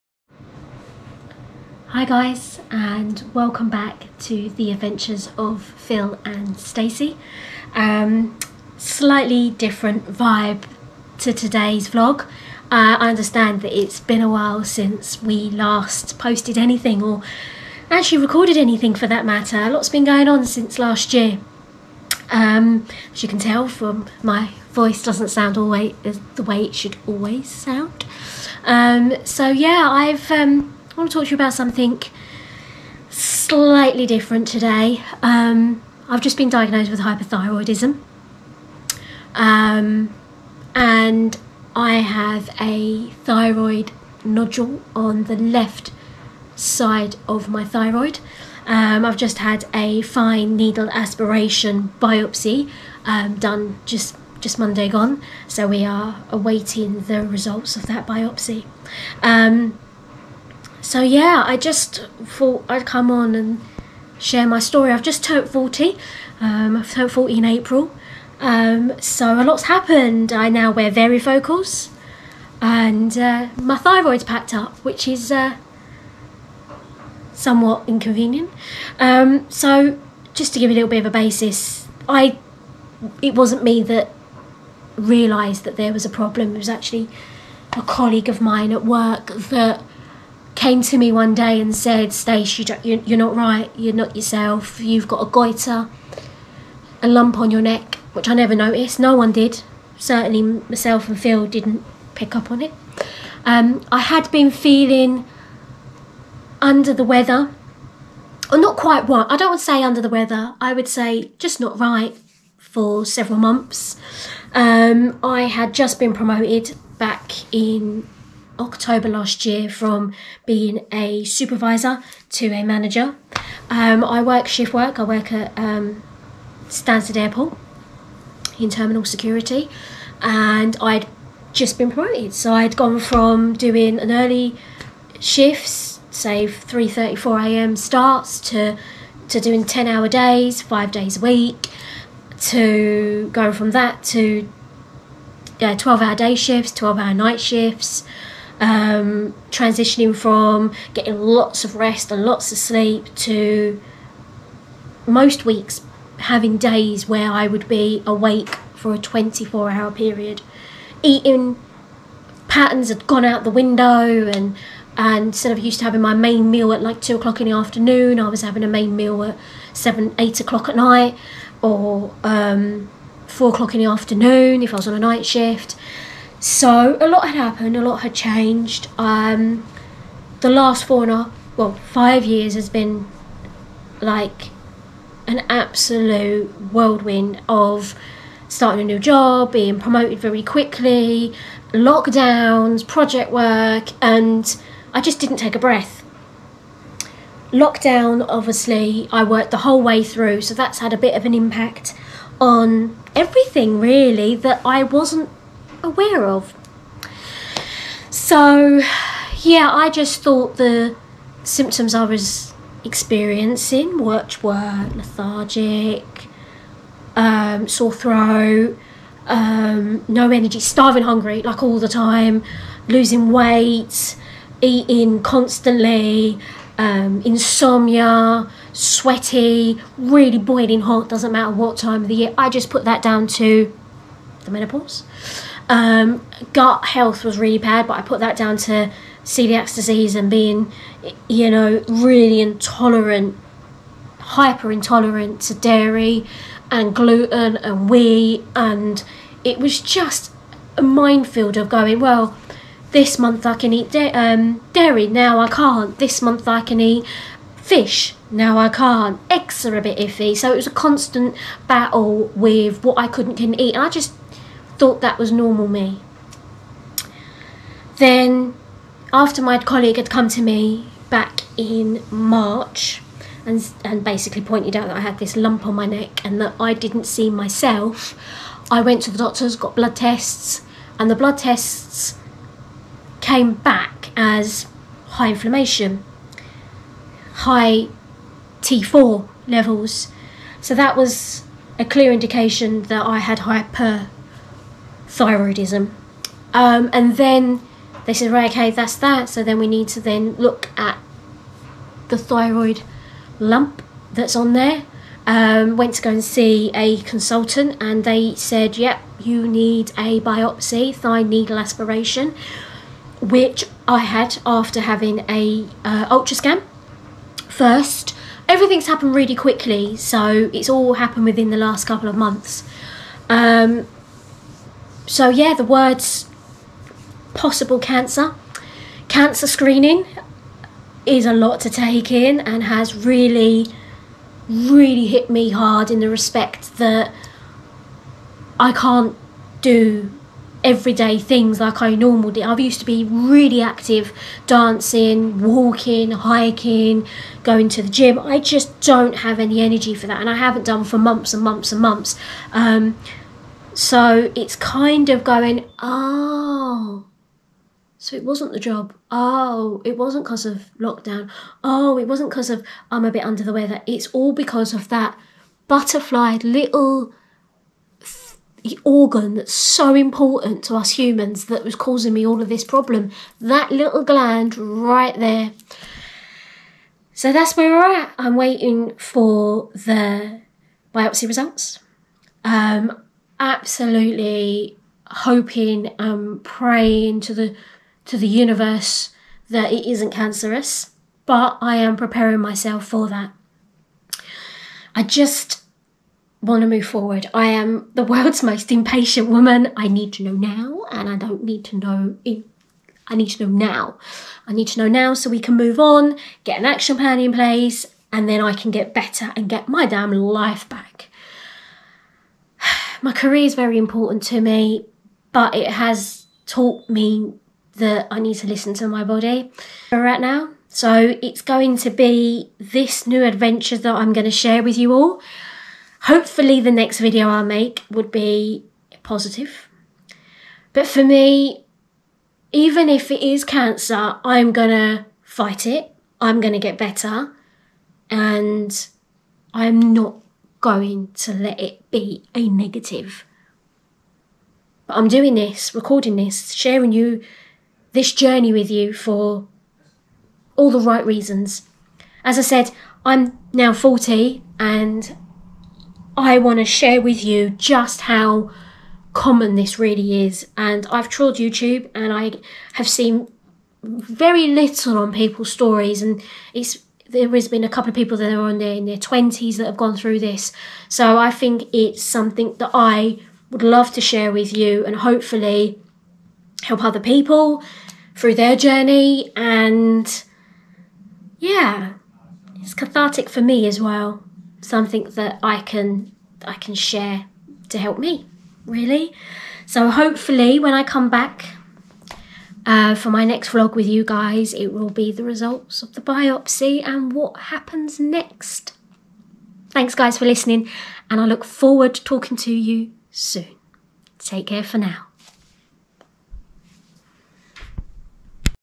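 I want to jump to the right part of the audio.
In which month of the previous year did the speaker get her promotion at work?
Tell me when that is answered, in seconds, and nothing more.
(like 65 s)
118 s.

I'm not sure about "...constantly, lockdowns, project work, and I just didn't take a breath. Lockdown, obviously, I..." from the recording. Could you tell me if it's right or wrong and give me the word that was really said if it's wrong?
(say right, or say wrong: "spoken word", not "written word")
wrong: "quickly", not "constantly".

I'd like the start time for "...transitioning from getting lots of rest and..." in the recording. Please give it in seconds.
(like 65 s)
149 s.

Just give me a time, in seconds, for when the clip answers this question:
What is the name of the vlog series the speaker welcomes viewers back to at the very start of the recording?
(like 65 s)
4 s.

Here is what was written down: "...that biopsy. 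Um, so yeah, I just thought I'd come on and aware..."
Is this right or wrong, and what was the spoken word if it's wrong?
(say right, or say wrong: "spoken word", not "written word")
wrong: "share", not "aware".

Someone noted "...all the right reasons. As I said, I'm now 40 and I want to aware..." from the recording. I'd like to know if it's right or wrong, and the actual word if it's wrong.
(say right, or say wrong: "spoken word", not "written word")
wrong: "share", not "aware".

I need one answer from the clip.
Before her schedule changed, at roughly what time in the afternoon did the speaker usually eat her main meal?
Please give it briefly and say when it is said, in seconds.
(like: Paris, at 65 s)
2 o'clock, at 167 s.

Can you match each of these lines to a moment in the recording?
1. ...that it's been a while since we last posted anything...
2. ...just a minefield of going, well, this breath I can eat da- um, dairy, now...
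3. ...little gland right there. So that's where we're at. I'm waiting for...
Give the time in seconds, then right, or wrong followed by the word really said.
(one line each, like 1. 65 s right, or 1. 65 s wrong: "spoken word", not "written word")
1. 13 s right
2. 249 s wrong: "month", not "breath"
3. 373 s right.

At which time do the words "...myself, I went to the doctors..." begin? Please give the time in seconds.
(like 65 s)
277 s.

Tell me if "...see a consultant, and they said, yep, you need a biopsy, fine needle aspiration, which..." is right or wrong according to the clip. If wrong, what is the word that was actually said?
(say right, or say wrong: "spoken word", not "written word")
right.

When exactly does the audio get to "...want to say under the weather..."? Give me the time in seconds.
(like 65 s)
109 s.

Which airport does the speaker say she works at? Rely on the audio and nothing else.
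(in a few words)
Stansted Airport.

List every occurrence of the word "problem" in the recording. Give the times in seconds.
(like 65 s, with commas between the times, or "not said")
86 s, 372 s.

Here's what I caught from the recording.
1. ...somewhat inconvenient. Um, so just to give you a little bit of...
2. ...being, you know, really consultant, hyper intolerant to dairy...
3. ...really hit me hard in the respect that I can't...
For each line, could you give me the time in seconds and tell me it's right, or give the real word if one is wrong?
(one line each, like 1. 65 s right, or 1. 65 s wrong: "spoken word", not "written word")
1. 77 s right
2. 240 s wrong: "intolerant", not "consultant"
3. 334 s right.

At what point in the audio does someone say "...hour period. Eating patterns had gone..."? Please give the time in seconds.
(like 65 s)
159 s.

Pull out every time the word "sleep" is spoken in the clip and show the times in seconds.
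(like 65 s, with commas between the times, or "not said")
152 s.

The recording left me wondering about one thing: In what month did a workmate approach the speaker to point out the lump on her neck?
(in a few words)
March.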